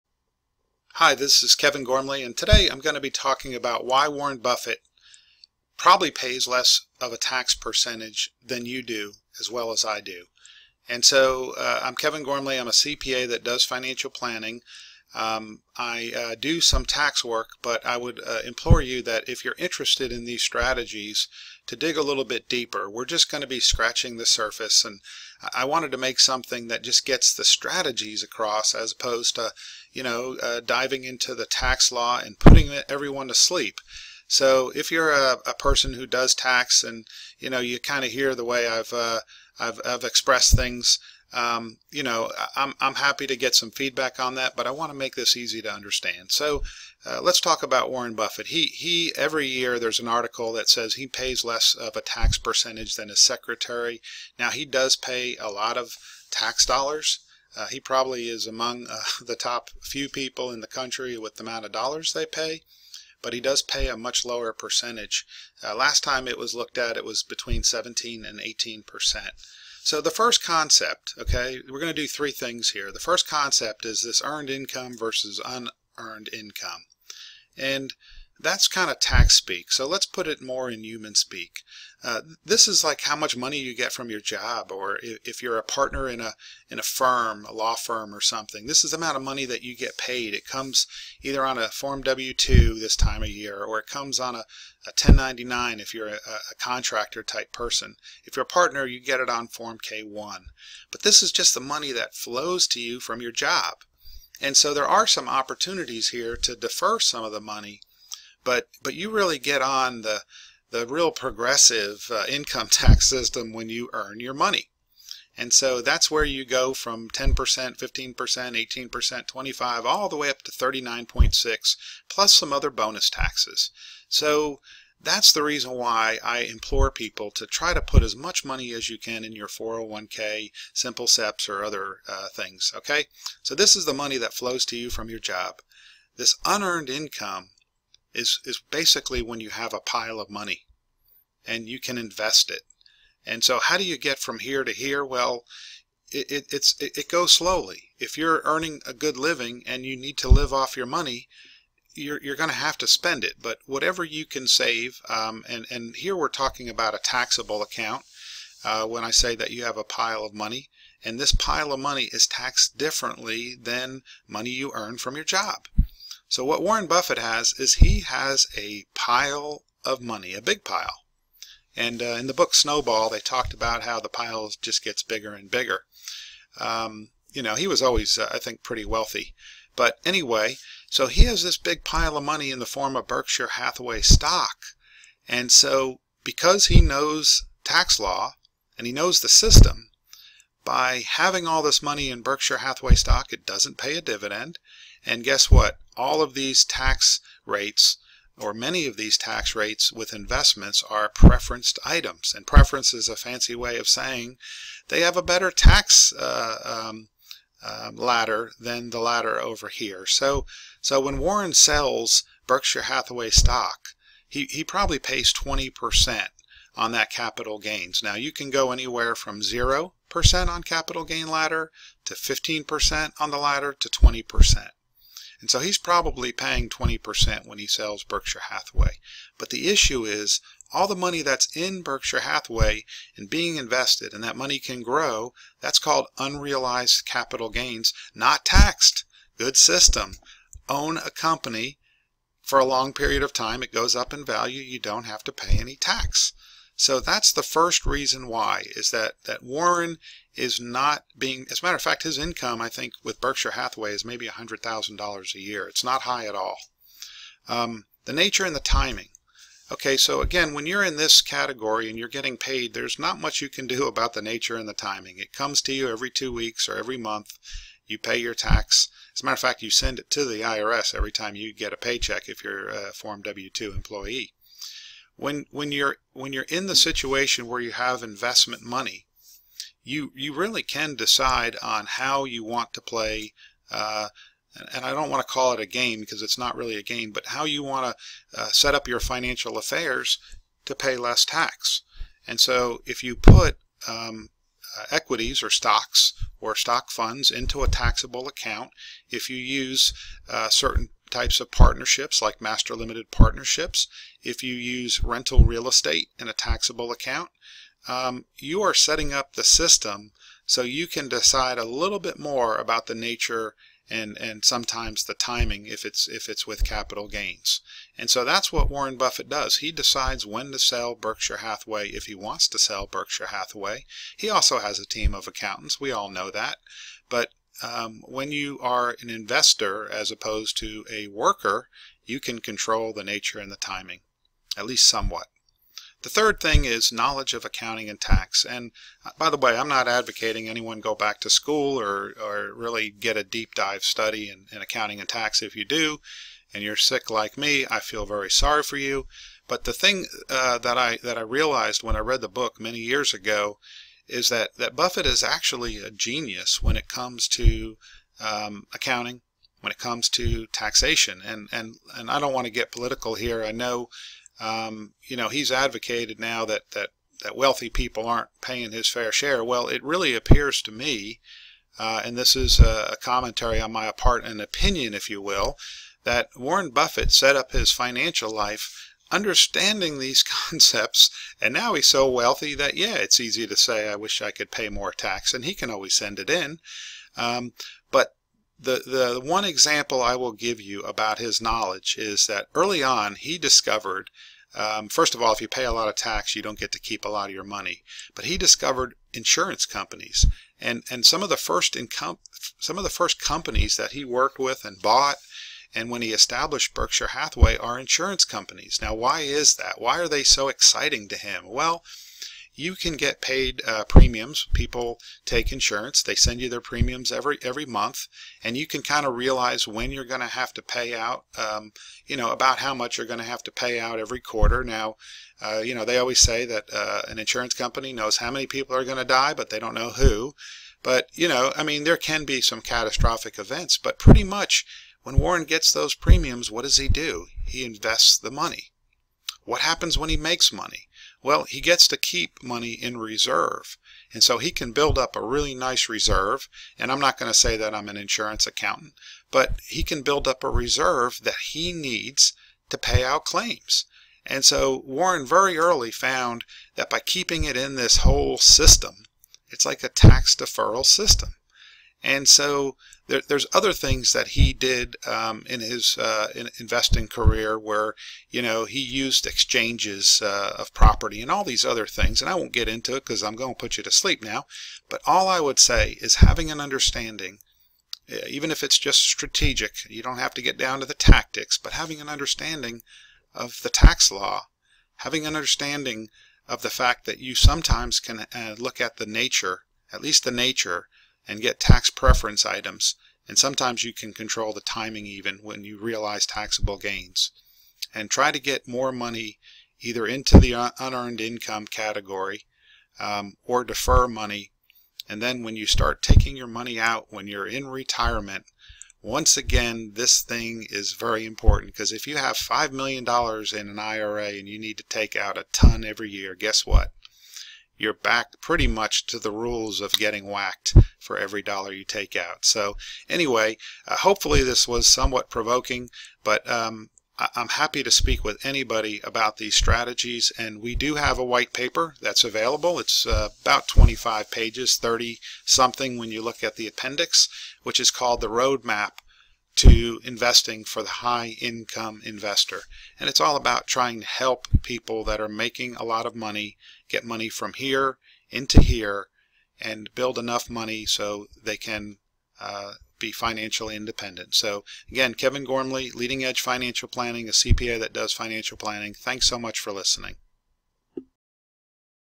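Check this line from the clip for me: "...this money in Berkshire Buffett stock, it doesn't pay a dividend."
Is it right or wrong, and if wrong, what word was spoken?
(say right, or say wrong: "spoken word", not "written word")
wrong: "Hathaway", not "Buffett".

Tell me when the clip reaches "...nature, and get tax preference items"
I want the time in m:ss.
8:10.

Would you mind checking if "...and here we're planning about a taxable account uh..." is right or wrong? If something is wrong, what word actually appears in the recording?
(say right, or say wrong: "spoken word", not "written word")
wrong: "talking", not "planning".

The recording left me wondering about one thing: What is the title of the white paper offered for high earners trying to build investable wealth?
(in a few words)
Roadmap to investing.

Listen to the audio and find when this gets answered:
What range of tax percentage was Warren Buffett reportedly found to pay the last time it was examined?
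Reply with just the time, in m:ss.
1:07.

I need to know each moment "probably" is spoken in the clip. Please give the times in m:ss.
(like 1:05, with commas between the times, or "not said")
0:05, 0:57, 3:34, 3:45.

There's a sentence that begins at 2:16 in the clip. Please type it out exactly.
This unearned income is, is basically when you have a pile of money and you can invest it.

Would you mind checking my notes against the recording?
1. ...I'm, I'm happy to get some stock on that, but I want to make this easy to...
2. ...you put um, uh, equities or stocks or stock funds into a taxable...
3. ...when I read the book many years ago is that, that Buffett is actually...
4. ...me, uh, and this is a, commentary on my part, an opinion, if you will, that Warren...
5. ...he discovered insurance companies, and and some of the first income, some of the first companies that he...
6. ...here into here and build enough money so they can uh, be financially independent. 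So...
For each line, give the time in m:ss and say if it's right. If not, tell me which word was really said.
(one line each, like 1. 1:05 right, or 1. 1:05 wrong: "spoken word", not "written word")
1. 0:42 wrong: "feedback", not "stock"
2. 4:53 right
3. 5:51 right
4. 6:10 right
5. 6:38 right
6. 9:07 right.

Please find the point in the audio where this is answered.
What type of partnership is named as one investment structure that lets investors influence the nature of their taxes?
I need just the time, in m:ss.
5:02.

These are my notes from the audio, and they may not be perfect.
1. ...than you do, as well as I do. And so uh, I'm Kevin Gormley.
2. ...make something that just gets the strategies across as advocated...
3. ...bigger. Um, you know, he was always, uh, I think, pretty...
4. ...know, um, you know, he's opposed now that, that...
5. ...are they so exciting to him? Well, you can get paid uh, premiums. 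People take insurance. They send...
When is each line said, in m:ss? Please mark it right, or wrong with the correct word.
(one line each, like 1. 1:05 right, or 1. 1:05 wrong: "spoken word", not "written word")
1. 0:08 right
2. 0:25 wrong: "opposed", not "advocated"
3. 2:55 right
4. 6:03 wrong: "advocated", not "opposed"
5. 6:49 right.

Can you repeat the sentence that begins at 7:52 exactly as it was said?
And I won't get into it because I'm going to put you to sleep now.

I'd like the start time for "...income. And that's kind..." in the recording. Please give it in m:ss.
1:16.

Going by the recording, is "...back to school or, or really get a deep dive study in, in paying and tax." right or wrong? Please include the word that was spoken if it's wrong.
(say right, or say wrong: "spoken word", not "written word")
wrong: "accounting", not "paying".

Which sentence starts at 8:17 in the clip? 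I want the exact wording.
And try to get more money either into the unearned income category um, or defer money.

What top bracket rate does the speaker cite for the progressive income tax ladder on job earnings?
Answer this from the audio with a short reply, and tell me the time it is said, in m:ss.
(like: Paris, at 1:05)
39.6%, at 2:00.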